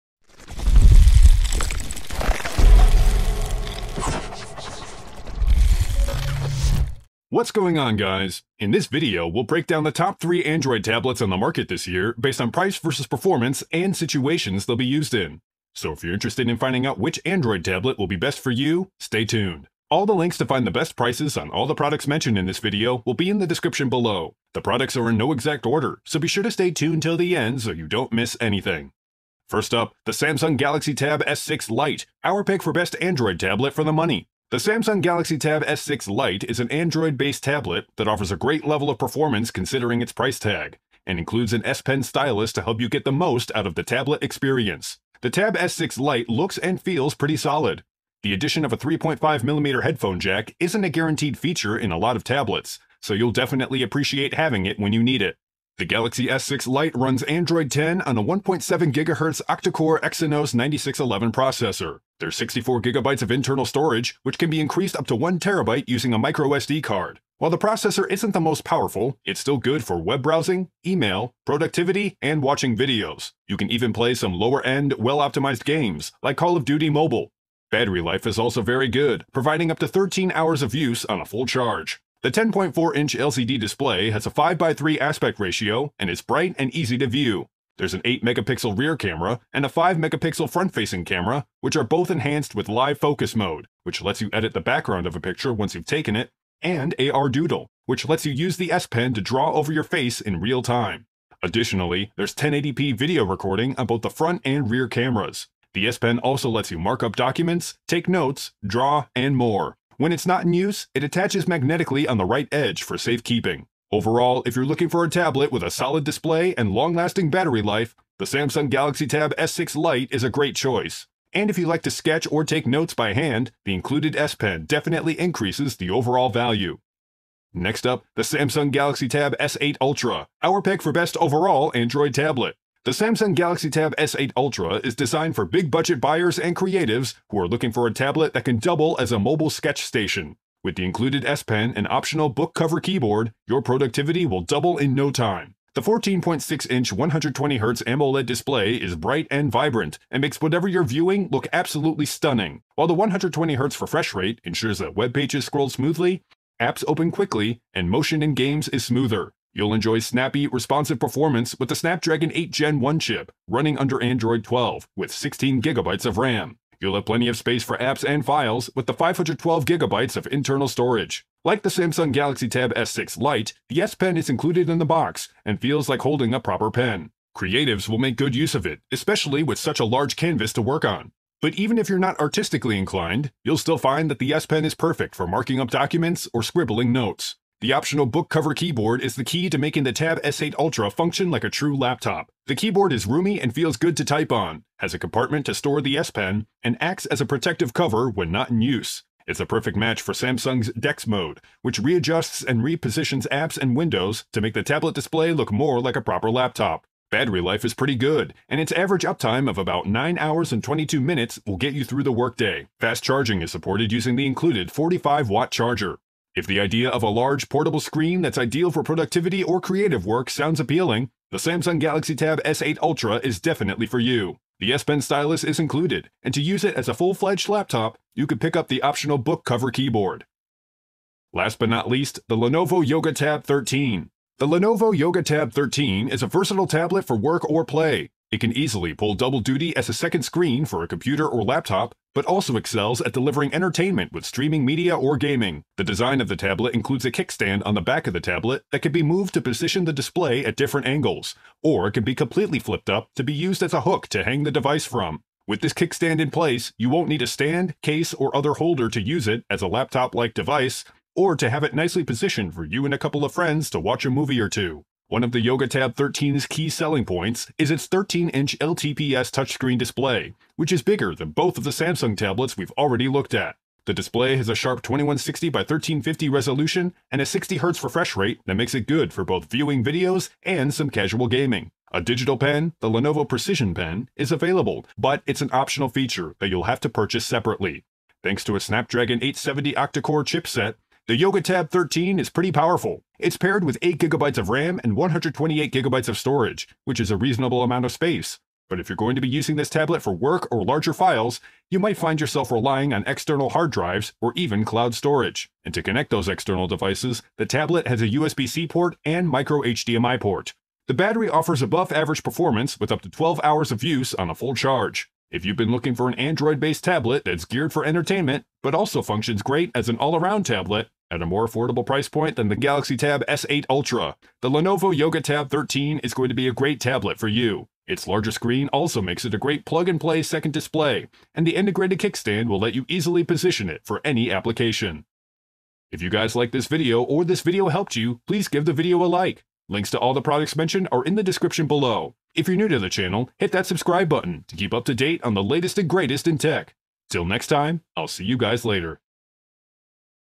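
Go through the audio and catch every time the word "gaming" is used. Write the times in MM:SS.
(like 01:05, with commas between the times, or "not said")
04:05, 04:41.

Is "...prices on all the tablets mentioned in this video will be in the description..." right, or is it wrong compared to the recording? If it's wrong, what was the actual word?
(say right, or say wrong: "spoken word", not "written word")
wrong: "products", not "tablets".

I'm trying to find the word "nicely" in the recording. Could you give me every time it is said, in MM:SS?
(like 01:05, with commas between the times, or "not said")
04:21.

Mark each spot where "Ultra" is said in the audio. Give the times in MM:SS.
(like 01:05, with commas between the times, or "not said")
02:09, 02:14, 03:10, 03:42, 05:23.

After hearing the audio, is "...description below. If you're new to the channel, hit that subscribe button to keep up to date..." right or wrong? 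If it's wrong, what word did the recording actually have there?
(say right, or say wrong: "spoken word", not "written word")
right.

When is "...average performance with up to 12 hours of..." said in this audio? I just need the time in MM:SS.
05:11.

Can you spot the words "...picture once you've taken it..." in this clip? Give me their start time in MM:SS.
01:35.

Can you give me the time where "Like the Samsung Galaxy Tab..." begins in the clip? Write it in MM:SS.
02:51.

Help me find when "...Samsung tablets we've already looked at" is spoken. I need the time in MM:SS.
04:31.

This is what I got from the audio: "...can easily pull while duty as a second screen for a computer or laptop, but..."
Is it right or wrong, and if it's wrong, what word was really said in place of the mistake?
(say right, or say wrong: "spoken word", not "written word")
wrong: "double", not "while".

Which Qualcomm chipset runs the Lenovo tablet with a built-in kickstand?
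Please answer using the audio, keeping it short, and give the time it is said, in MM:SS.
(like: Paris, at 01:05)
Snapdragon 870, at 04:48.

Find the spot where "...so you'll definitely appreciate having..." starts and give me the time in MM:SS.
00:53.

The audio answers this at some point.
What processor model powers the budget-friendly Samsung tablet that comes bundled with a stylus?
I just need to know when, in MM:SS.
01:00.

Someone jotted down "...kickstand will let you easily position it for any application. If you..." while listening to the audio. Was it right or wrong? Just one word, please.
right.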